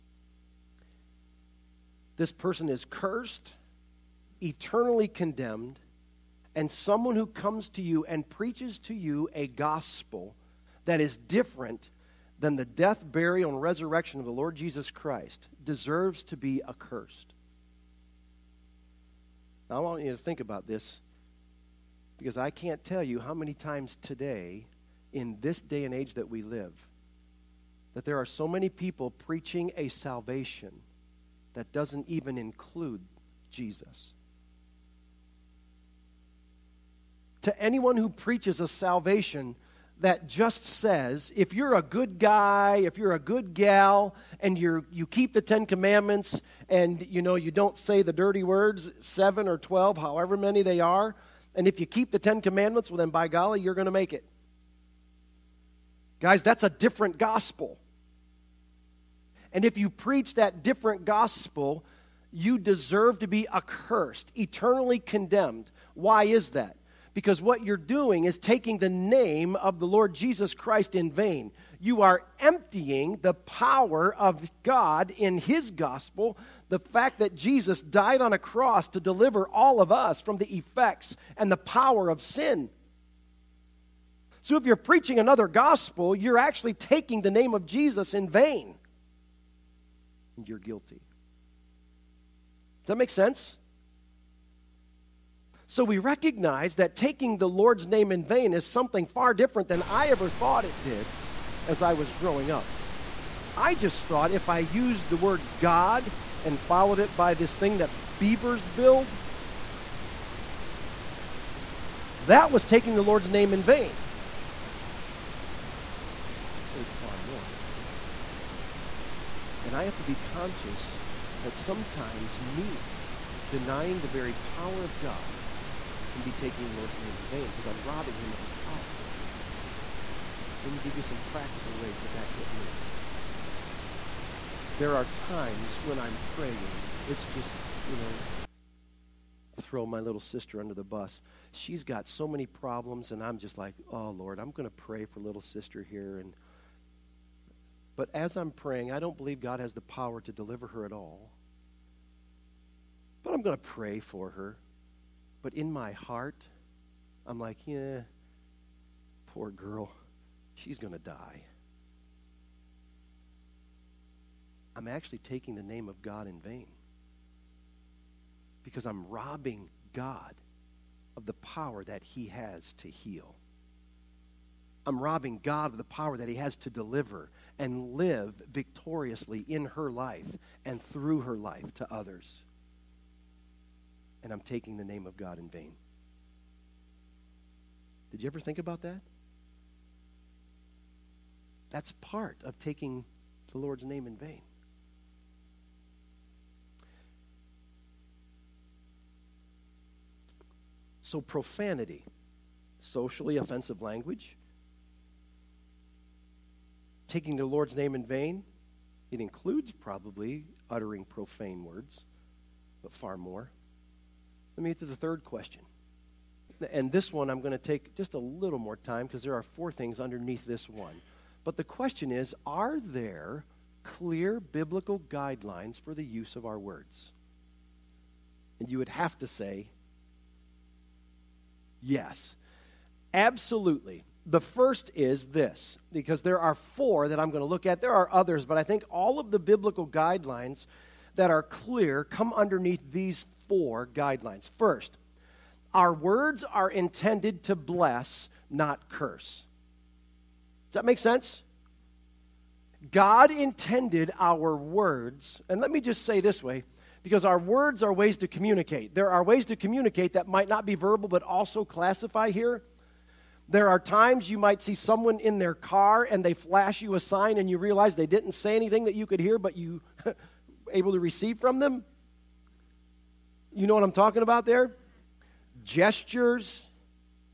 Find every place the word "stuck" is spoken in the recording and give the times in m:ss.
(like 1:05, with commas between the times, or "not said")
not said.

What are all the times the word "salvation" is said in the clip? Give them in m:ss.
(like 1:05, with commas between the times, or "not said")
0:29, 0:38.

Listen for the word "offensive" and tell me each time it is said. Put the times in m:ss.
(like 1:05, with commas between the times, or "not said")
3:23.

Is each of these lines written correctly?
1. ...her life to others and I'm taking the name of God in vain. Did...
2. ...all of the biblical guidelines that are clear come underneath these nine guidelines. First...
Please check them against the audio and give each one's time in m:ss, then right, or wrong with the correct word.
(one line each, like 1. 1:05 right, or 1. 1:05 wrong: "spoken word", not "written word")
1. 3:01 right
2. 3:58 wrong: "four", not "nine".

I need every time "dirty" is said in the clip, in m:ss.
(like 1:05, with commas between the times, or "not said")
0:48.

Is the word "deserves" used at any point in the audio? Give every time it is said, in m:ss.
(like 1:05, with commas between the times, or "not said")
0:15, 1:02.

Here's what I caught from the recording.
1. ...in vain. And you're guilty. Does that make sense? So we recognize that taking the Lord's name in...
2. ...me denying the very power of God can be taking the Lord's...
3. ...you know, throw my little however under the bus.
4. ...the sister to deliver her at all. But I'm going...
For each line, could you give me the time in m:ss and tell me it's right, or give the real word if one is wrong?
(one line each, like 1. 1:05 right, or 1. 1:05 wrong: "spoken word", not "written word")
1. 1:28 right
2. 2:02 right
3. 2:17 wrong: "sister", not "however"
4. 2:29 wrong: "power", not "sister".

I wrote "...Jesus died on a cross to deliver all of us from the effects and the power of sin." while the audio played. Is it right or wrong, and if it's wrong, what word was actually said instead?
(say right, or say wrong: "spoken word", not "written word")
right.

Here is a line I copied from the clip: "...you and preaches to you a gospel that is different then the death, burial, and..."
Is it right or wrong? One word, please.
right.